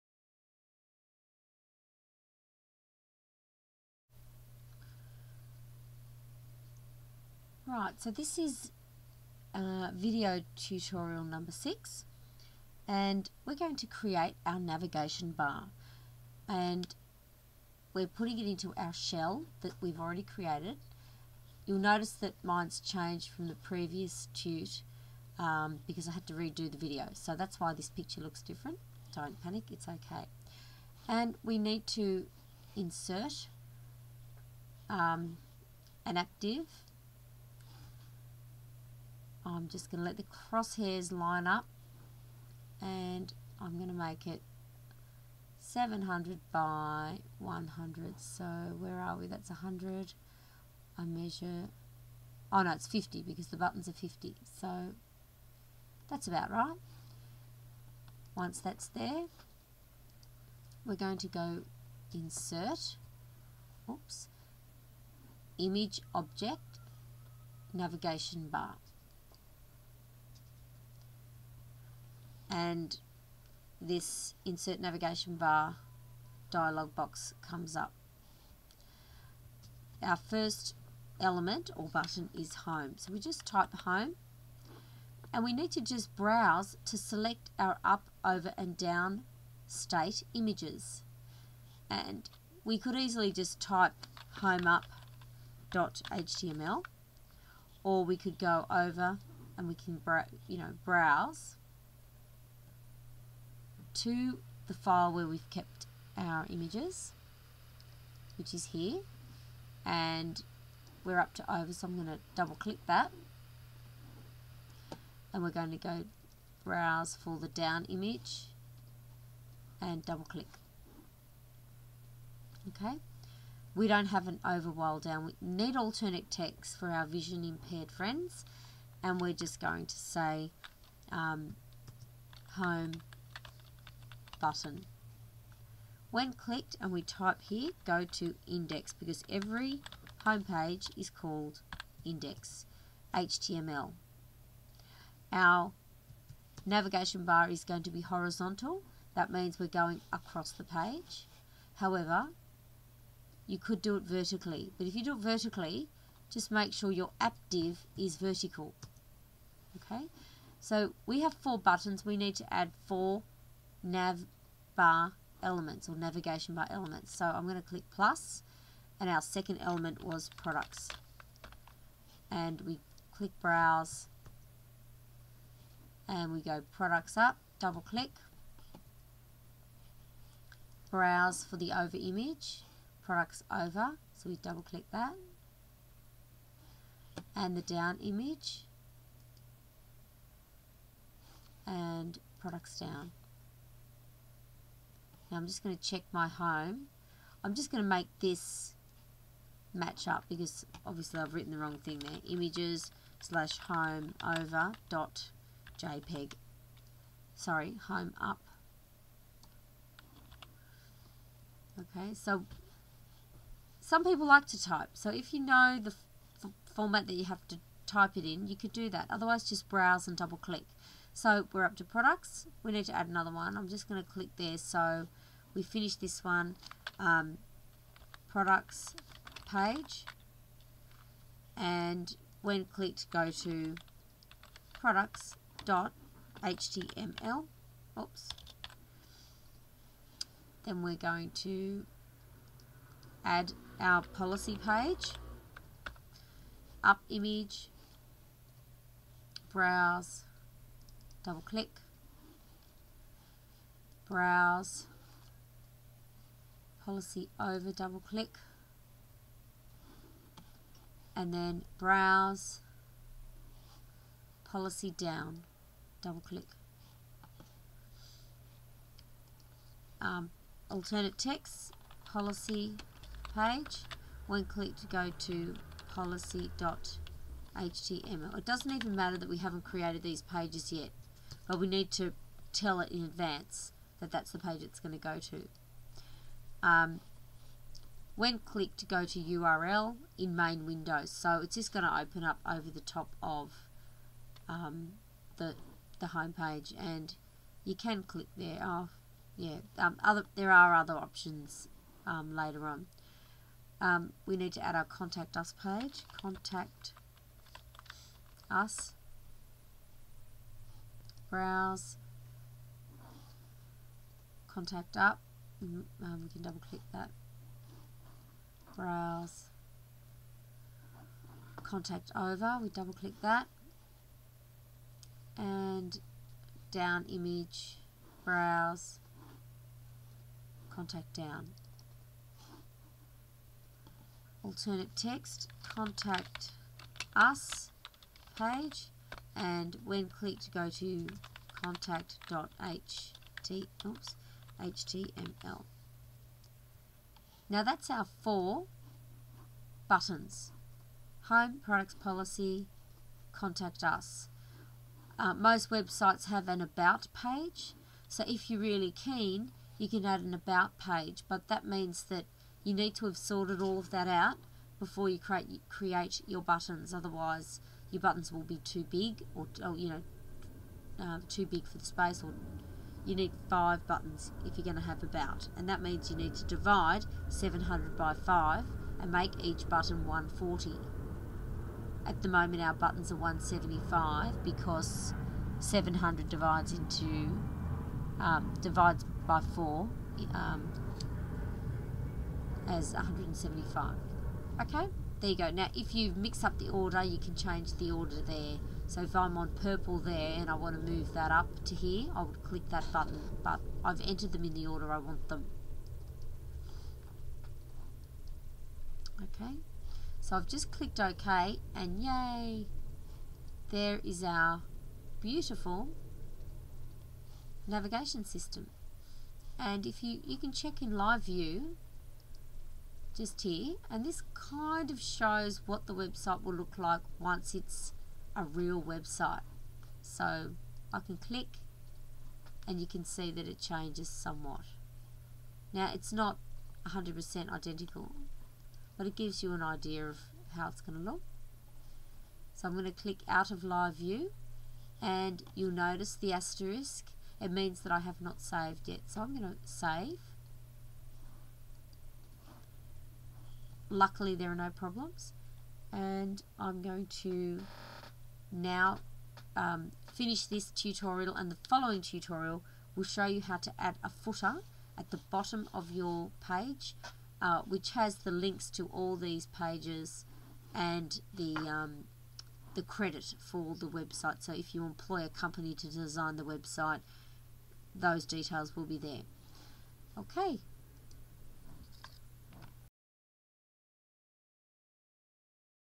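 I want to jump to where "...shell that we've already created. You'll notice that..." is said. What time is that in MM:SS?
00:18.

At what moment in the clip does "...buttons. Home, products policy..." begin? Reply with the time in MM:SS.
05:49.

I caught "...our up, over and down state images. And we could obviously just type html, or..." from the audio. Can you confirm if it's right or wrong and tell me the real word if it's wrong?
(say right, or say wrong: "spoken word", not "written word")
wrong: "easily", not "obviously".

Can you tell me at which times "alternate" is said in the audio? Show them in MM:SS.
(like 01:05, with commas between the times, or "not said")
02:05, 04:30, 05:34.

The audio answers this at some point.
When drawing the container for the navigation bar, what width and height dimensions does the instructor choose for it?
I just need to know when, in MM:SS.
00:45.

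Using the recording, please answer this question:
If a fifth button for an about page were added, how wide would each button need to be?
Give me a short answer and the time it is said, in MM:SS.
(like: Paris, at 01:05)
140, at 06:20.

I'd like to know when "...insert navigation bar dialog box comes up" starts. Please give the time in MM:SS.
01:14.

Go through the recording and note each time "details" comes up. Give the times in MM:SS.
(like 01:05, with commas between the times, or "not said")
07:58.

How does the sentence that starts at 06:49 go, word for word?
Okay, so I've just clicked OK and yay, there is our beautiful navigation system.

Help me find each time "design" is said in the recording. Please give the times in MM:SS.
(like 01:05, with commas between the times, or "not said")
07:55.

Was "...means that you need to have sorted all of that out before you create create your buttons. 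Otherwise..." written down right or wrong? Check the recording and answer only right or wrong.
right.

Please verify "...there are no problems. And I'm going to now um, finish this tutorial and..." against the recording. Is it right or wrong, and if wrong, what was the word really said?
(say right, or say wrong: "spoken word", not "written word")
right.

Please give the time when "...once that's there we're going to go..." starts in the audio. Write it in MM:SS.
00:58.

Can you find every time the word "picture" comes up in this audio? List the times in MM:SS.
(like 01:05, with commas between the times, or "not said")
00:27.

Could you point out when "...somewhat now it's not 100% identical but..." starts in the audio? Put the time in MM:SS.
07:14.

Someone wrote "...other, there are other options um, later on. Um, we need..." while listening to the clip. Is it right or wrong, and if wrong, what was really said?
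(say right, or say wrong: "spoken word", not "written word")
right.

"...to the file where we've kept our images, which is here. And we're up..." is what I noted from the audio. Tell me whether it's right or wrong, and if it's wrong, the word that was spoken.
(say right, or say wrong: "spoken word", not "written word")
right.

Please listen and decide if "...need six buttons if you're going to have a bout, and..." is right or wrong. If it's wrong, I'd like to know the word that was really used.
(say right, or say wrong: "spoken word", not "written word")
wrong: "five", not "six".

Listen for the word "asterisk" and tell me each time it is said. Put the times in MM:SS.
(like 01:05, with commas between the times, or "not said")
07:26.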